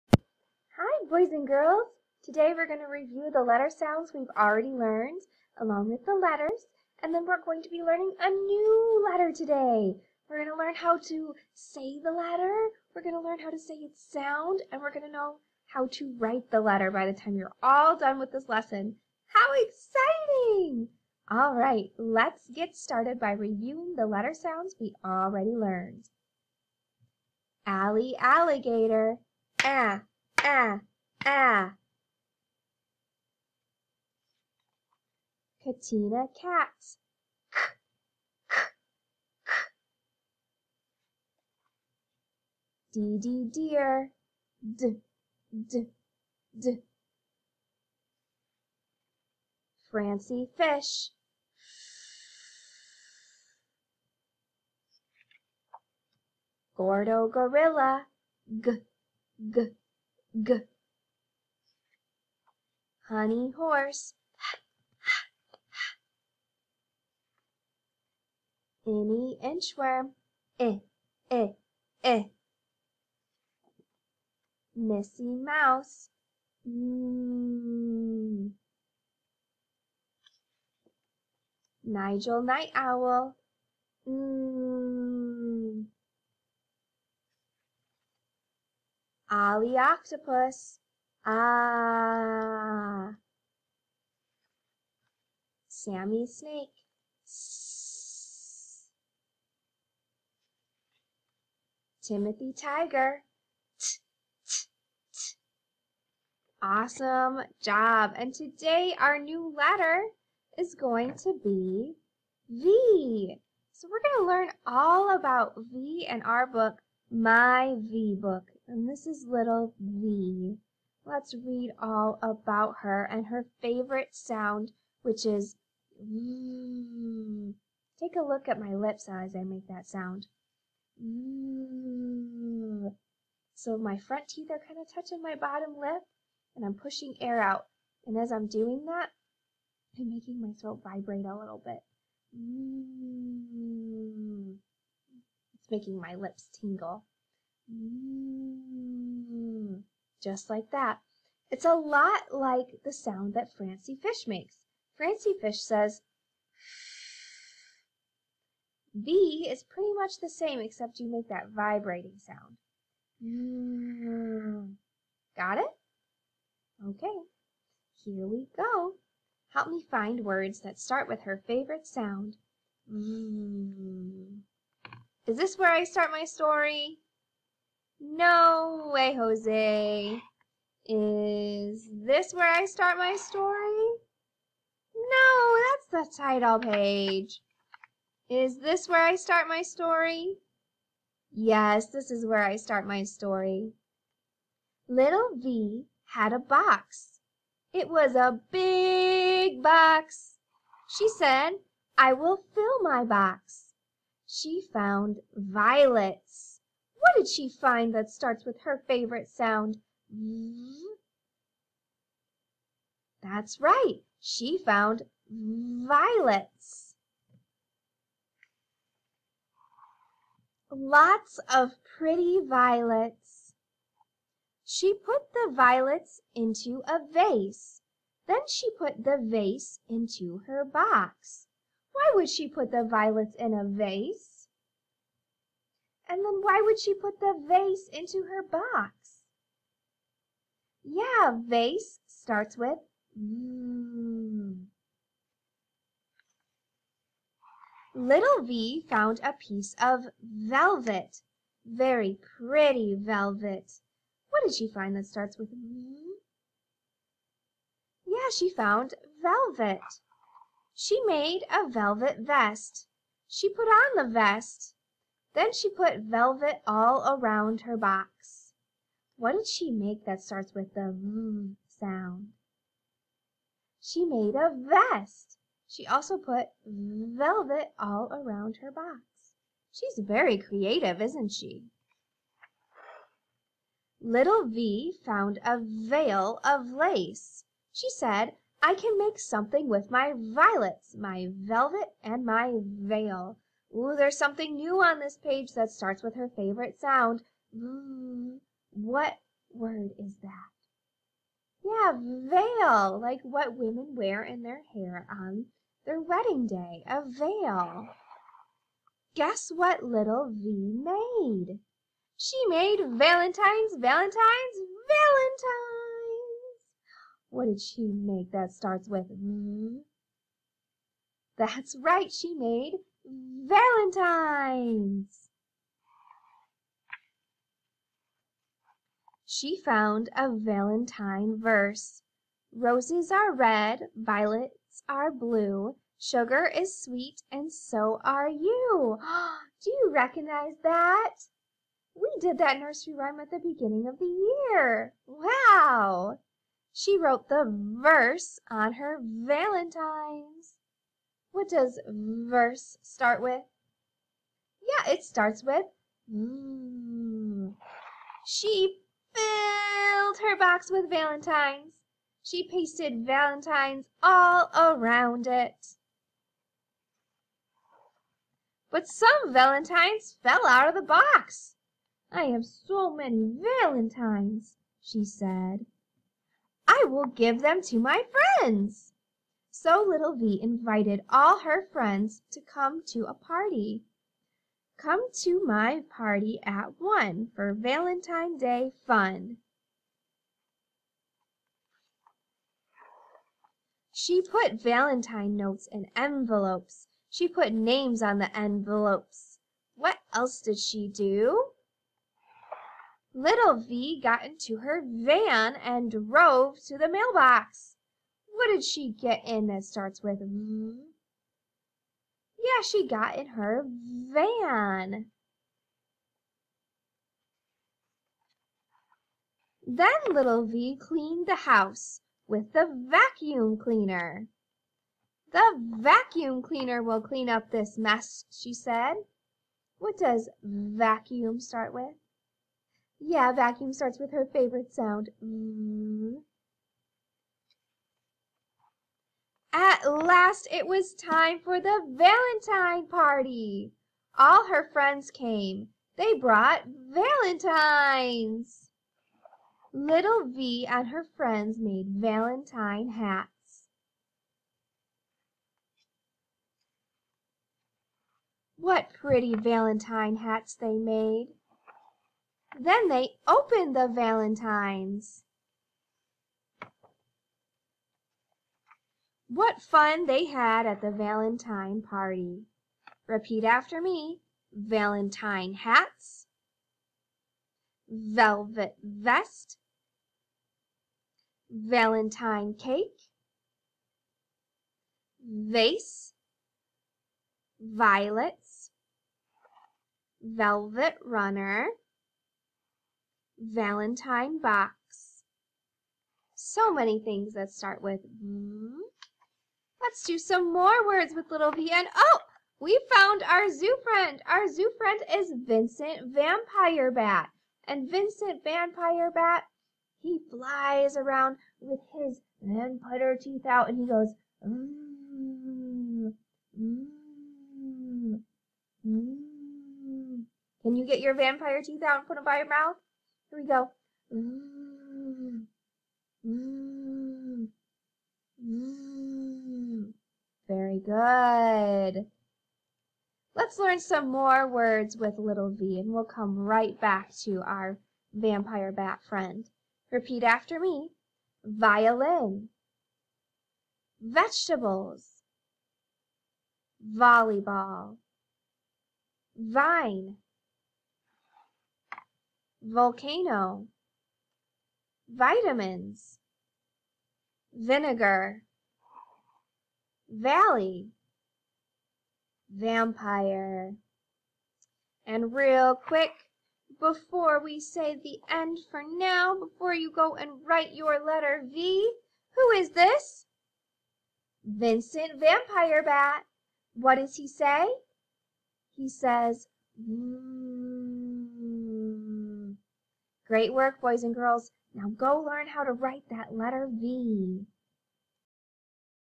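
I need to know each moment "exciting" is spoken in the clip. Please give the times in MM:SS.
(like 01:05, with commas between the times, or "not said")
00:19.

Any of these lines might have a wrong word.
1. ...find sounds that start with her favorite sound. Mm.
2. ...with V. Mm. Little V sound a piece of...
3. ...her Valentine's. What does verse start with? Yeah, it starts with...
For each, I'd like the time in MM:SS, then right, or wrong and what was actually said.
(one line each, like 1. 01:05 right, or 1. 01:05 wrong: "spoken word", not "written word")
1. 02:49 wrong: "words", not "sounds"
2. 04:02 wrong: "found", not "sound"
3. 05:48 right.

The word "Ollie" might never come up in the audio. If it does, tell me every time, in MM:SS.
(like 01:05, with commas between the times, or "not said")
01:29.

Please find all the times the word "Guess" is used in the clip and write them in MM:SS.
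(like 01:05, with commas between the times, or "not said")
05:09.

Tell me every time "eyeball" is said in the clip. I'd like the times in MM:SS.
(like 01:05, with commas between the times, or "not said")
not said.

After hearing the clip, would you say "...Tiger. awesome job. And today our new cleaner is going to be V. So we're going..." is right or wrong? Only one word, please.
wrong.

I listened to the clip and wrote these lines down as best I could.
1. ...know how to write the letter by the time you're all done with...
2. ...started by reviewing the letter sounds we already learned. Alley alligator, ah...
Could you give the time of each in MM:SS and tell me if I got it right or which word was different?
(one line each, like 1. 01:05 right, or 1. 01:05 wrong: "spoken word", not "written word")
1. 00:15 right
2. 00:22 right.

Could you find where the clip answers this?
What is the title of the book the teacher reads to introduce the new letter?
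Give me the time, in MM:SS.
01:57.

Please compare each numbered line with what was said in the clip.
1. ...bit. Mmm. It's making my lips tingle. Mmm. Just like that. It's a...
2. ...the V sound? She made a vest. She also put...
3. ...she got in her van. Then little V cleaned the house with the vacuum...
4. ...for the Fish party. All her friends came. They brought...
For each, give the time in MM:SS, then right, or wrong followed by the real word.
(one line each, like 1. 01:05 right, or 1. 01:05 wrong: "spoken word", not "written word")
1. 02:21 right
2. 04:30 right
3. 06:52 right
4. 07:21 wrong: "Valentine", not "Fish".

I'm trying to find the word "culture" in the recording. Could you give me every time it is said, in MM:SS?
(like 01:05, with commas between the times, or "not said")
not said.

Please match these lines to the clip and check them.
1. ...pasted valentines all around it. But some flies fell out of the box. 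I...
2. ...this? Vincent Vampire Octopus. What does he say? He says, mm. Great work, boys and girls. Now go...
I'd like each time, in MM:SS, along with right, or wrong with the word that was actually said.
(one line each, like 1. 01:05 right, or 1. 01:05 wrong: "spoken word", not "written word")
1. 06:02 wrong: "valentines", not "flies"
2. 09:32 wrong: "Bat", not "Octopus".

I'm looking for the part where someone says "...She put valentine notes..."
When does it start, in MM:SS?
06:34.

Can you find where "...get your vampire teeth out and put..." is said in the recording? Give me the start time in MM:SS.
08:40.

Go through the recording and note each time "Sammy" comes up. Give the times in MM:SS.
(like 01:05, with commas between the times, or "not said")
01:35.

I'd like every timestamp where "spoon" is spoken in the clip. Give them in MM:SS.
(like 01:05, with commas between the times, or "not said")
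not said.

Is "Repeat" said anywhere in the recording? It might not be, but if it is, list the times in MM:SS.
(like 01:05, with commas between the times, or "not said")
07:53, 08:59.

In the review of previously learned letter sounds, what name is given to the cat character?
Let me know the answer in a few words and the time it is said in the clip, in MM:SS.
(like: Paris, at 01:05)
Katina, at 00:35.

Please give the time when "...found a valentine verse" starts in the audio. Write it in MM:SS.
05:29.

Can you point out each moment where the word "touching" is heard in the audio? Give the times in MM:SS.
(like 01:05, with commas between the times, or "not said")
02:14.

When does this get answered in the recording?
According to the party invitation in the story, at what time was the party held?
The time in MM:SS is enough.
06:26.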